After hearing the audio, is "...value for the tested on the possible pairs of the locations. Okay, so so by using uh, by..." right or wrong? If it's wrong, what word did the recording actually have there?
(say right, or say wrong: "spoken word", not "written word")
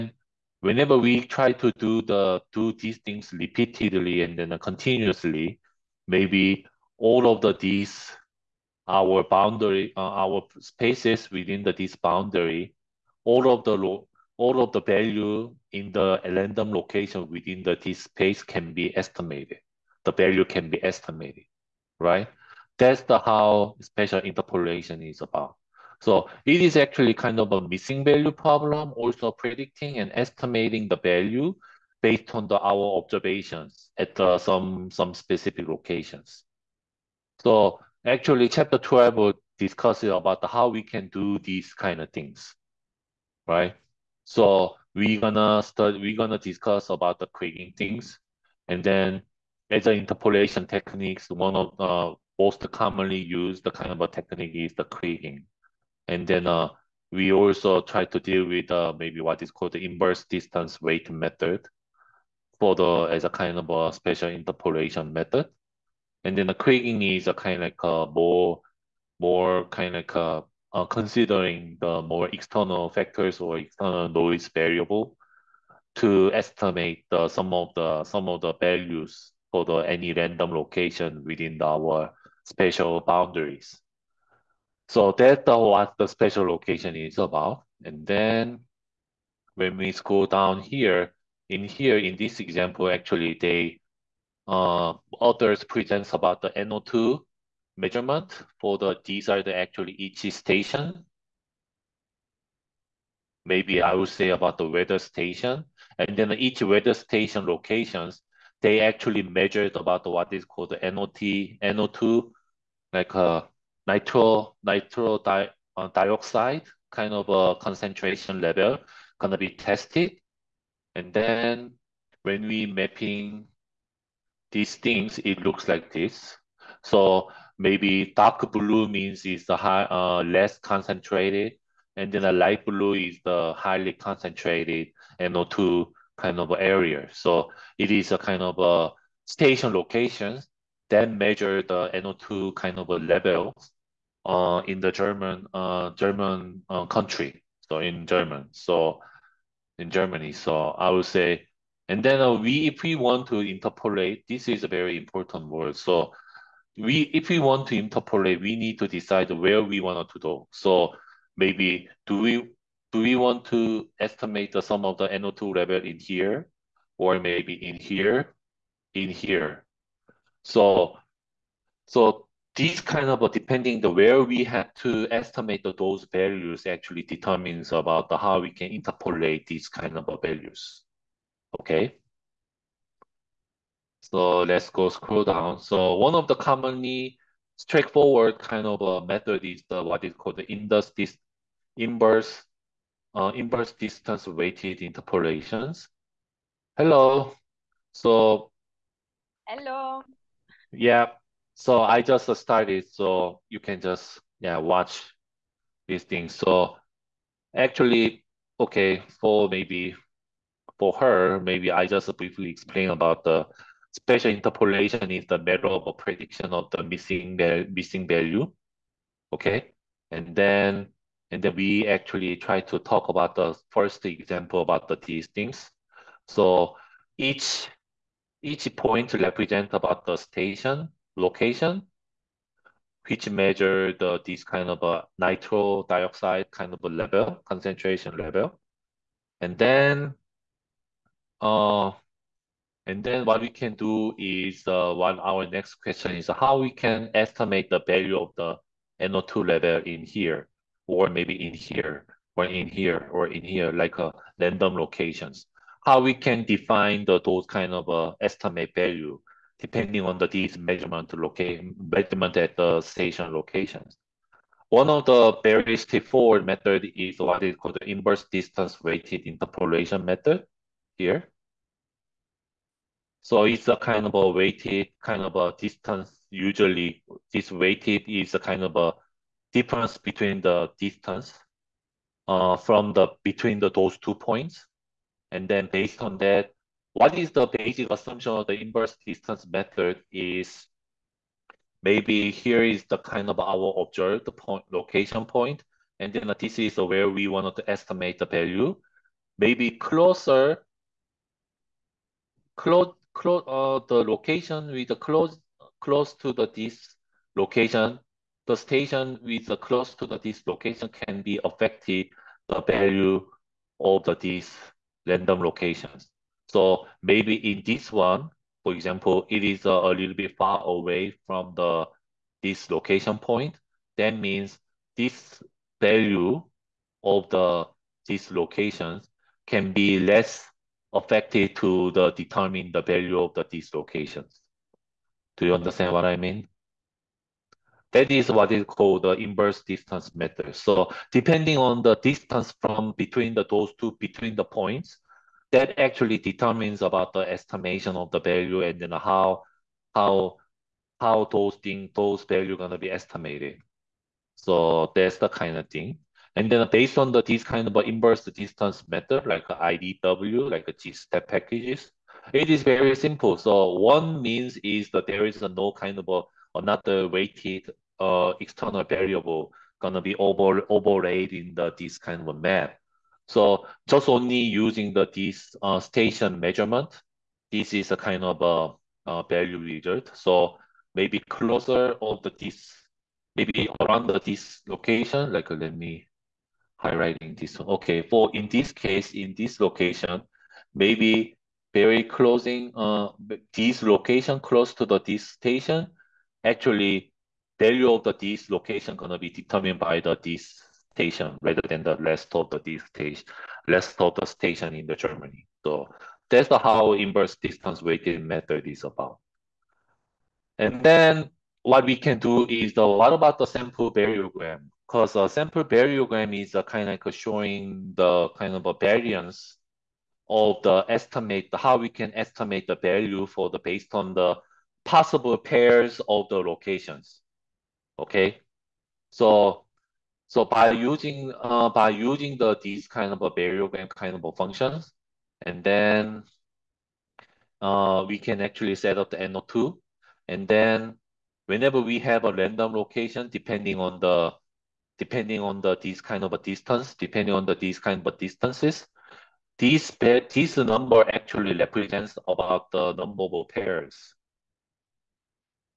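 wrong: "based", not "tested".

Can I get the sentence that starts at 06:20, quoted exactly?
So maybe closer of the this, maybe around the this location.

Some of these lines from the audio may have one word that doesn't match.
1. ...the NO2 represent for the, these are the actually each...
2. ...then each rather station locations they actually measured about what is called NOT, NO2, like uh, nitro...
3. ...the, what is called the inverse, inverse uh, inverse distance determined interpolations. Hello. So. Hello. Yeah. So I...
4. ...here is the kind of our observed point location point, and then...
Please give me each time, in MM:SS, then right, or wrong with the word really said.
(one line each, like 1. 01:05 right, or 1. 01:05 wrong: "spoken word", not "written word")
1. 01:36 wrong: "measurement", not "represent"
2. 01:46 wrong: "weather", not "rather"
3. 03:09 wrong: "weighted", not "determined"
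4. 04:52 right.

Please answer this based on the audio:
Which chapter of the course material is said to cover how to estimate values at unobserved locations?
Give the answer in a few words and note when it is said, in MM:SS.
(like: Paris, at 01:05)
Chapter 12, at 00:38.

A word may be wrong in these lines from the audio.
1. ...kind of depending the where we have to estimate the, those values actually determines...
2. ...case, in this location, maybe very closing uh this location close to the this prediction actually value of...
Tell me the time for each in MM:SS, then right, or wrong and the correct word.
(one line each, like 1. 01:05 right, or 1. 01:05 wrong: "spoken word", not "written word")
1. 02:52 right
2. 06:28 wrong: "station", not "prediction".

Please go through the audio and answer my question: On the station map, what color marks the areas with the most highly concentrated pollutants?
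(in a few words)
Light blue.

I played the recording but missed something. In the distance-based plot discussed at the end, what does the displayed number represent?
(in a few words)
Number of pairs.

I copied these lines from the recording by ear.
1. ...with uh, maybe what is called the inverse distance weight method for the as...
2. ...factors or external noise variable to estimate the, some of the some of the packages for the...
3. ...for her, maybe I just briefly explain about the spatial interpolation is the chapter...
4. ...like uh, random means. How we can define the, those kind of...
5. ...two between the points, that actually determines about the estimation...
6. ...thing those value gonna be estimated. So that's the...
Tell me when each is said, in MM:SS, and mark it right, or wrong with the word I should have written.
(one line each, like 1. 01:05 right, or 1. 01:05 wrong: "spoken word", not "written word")
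1. 00:58 right
2. 01:12 wrong: "values", not "packages"
3. 03:30 wrong: "matter", not "chapter"
4. 04:13 wrong: "locations", not "means"
5. 05:43 right
6. 05:51 right.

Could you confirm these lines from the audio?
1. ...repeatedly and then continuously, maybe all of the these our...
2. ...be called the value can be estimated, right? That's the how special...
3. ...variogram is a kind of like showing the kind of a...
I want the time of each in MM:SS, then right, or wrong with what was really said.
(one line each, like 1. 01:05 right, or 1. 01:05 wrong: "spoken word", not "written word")
1. 00:03 right
2. 00:18 wrong: "estimated", not "called"
3. 06:55 right.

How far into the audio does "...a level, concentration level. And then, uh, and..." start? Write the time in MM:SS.
03:56.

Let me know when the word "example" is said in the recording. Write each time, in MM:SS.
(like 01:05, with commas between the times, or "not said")
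01:32, 03:44, 05:18.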